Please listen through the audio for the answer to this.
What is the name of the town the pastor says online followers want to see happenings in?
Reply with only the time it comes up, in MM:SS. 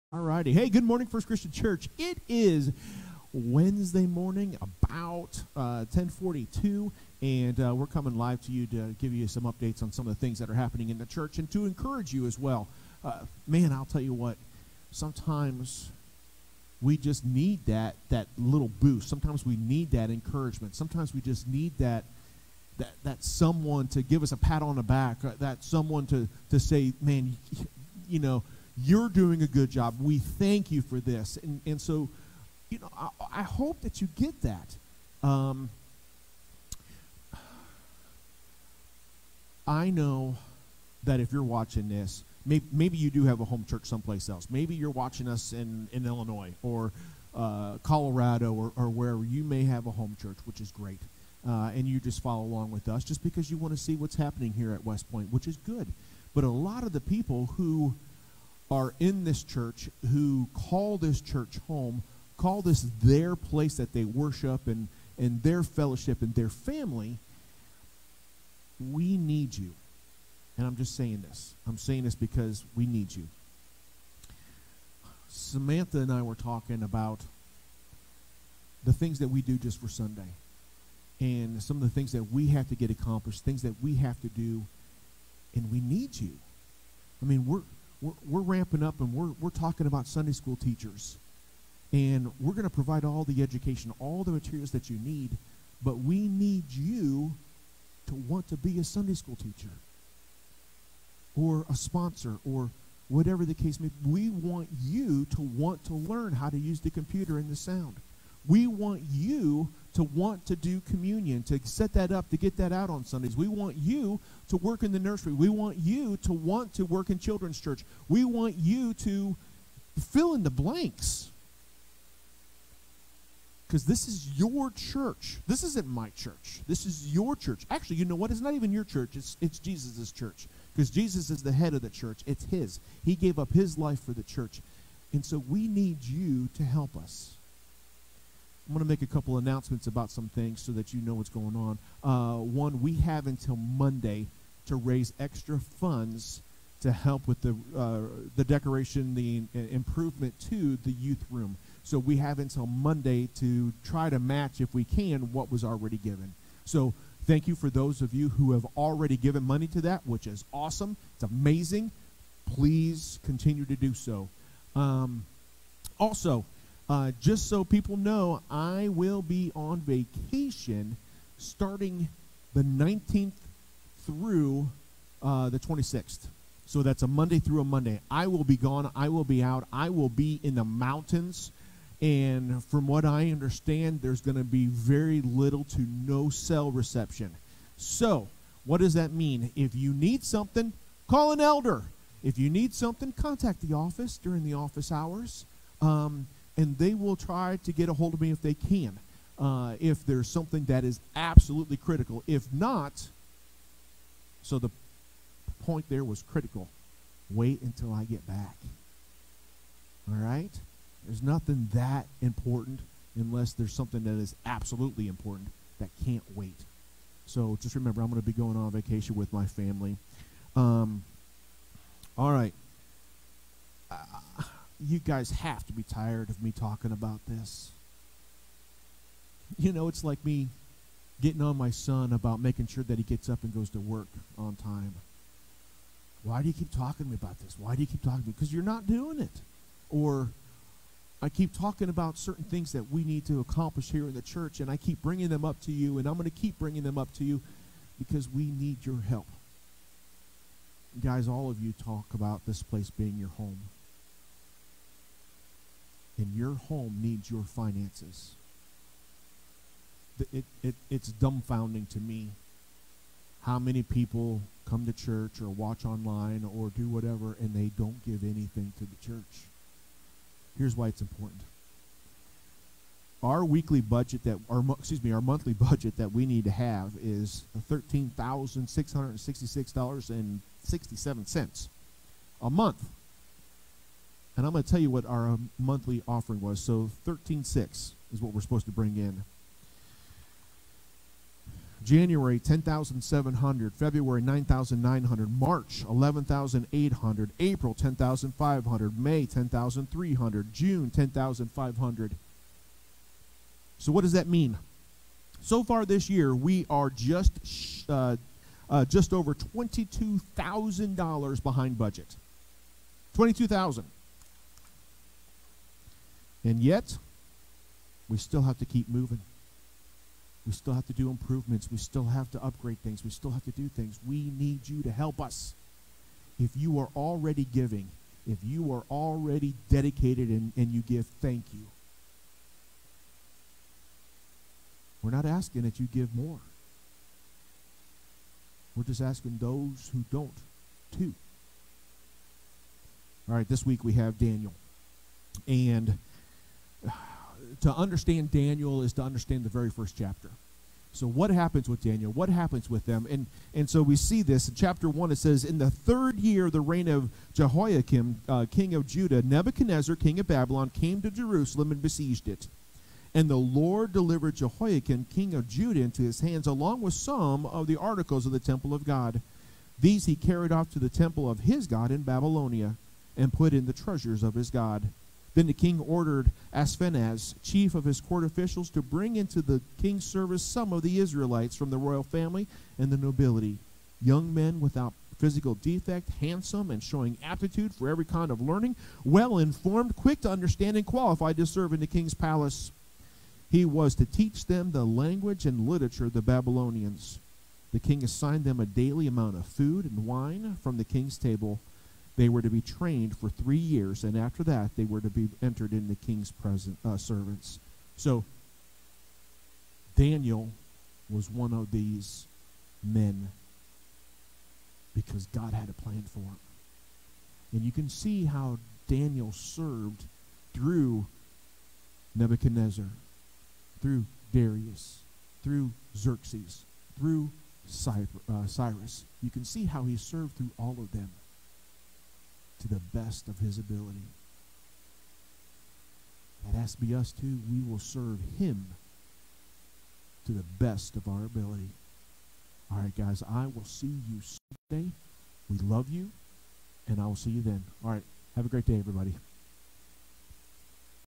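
00:54.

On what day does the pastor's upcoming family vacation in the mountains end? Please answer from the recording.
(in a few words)
26th.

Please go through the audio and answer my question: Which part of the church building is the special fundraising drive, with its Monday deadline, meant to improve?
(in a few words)
youth room.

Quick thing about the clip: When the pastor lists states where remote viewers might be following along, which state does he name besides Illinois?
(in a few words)
Colorado.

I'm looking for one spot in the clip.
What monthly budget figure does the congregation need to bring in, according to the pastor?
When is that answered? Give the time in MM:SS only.
04:37.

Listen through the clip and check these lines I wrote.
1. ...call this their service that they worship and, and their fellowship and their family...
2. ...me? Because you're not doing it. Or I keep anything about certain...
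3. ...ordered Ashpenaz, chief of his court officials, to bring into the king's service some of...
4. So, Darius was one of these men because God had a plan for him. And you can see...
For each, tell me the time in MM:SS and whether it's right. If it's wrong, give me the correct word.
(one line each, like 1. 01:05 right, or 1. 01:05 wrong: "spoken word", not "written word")
1. 01:02 wrong: "place", not "service"
2. 03:58 wrong: "talking", not "anything"
3. 06:15 right
4. 06:47 wrong: "Daniel", not "Darius".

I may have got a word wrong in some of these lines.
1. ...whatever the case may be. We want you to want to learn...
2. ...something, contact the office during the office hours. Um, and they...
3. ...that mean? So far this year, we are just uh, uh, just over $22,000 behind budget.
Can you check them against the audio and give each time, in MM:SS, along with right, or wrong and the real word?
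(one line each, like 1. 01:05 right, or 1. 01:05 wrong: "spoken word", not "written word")
1. 01:43 right
2. 03:12 right
3. 05:04 right.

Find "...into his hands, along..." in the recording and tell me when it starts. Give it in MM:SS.
06:05.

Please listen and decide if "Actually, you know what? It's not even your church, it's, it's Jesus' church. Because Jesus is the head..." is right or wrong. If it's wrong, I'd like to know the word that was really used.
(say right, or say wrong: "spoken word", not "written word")
right.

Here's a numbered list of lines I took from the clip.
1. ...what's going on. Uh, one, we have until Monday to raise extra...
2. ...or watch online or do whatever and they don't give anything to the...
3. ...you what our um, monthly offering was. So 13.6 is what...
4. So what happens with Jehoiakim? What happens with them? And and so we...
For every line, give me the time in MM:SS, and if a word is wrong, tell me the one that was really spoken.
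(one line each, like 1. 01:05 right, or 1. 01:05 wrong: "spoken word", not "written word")
1. 02:21 right
2. 04:25 right
3. 04:44 right
4. 05:50 wrong: "Daniel", not "Jehoiakim".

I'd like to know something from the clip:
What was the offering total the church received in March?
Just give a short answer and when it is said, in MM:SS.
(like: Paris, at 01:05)
$11,800, at 04:55.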